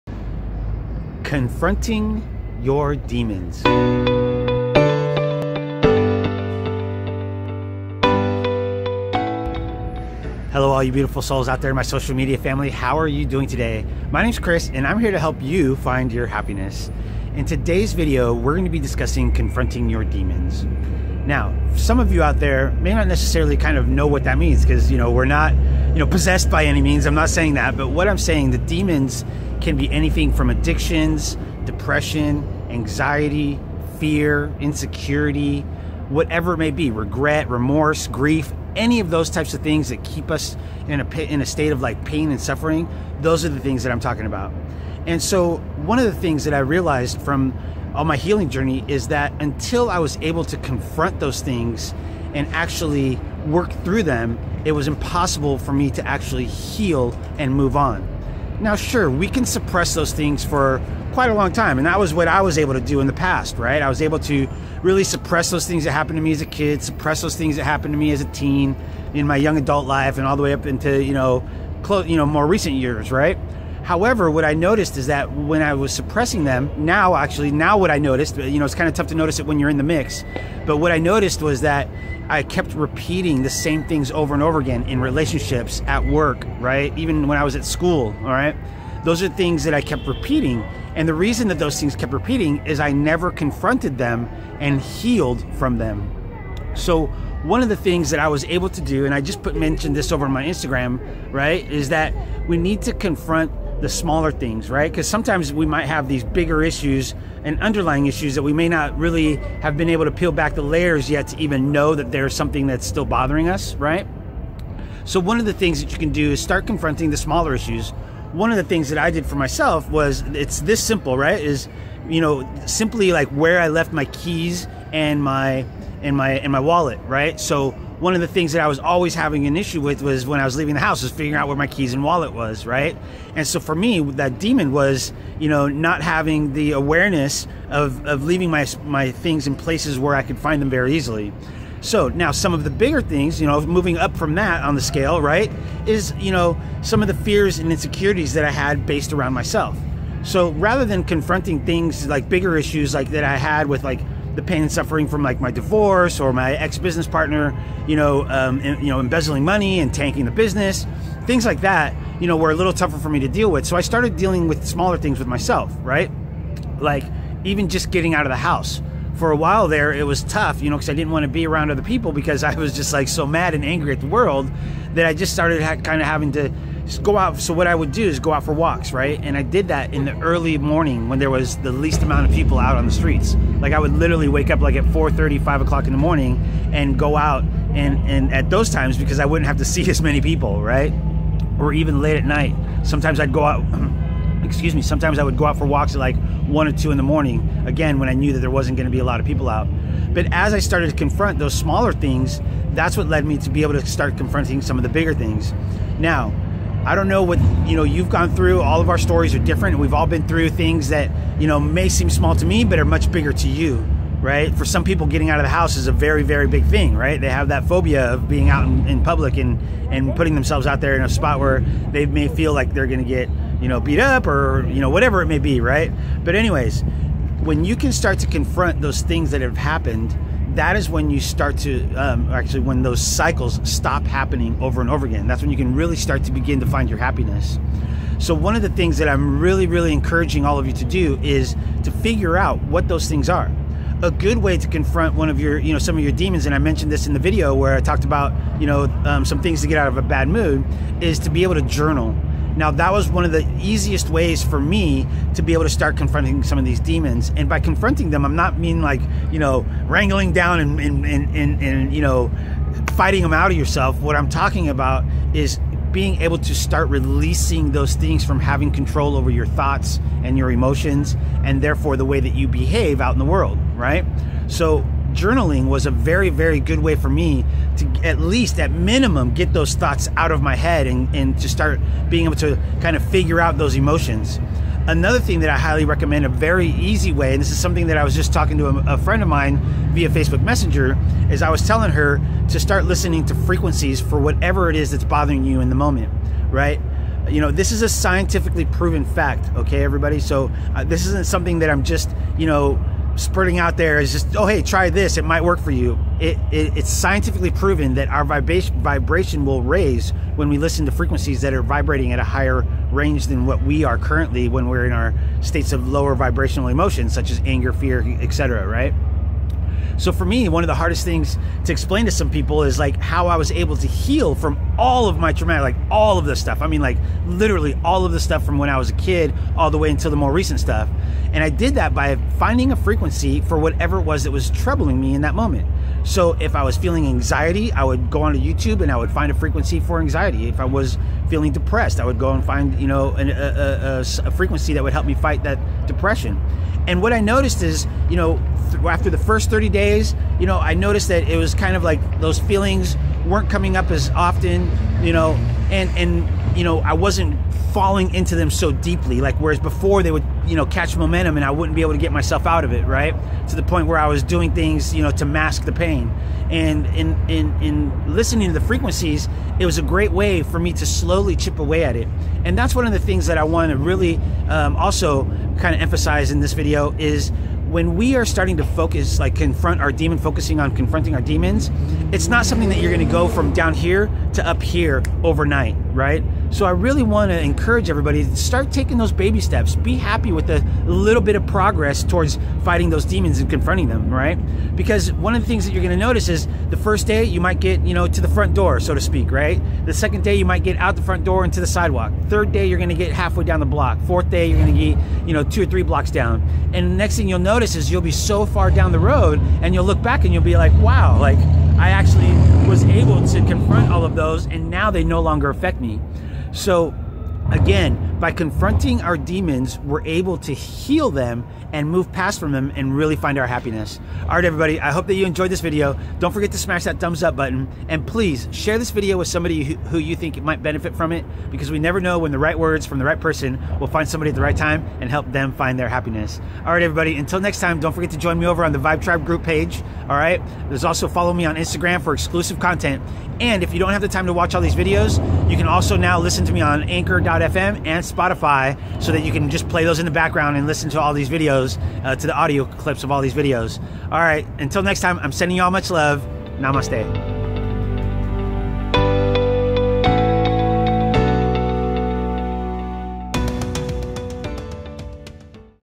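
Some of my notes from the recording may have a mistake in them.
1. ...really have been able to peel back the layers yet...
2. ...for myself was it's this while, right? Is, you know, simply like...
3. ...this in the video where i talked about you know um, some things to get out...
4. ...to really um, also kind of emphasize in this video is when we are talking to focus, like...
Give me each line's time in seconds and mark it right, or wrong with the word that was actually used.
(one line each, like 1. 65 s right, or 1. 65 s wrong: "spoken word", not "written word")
1. 108 s right
2. 119 s wrong: "simple", not "while"
3. 246 s right
4. 373 s wrong: "starting", not "talking".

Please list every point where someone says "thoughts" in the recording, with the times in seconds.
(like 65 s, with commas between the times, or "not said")
269 s, 279 s.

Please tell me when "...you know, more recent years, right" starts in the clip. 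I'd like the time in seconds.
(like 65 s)
72 s.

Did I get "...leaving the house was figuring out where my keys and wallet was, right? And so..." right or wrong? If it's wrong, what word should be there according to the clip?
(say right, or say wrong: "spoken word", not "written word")
right.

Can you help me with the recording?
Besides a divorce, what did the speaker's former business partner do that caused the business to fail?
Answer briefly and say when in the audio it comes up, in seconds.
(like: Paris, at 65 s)
embezzling money, at 158 s.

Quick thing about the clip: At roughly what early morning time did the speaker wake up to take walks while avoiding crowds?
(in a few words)
4:30.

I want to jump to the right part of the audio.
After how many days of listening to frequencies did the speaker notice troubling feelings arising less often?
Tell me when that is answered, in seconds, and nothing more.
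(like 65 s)
349 s.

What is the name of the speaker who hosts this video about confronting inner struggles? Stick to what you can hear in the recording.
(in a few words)
Chris.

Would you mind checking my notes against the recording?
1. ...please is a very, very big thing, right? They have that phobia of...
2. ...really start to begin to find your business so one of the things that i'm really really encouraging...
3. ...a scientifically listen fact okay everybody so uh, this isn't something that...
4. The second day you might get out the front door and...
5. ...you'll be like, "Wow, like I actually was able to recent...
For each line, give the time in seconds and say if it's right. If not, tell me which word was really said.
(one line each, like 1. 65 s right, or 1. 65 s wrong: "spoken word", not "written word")
1. 215 s wrong: "house", not "please"
2. 235 s wrong: "happiness", not "business"
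3. 297 s wrong: "proven", not "listen"
4. 399 s right
5. 410 s wrong: "confront", not "recent".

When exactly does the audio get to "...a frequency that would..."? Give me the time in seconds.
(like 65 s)
344 s.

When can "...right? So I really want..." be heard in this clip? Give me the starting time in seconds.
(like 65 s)
385 s.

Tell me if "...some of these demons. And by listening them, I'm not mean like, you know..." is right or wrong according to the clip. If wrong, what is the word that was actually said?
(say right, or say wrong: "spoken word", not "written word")
wrong: "confronting", not "listening".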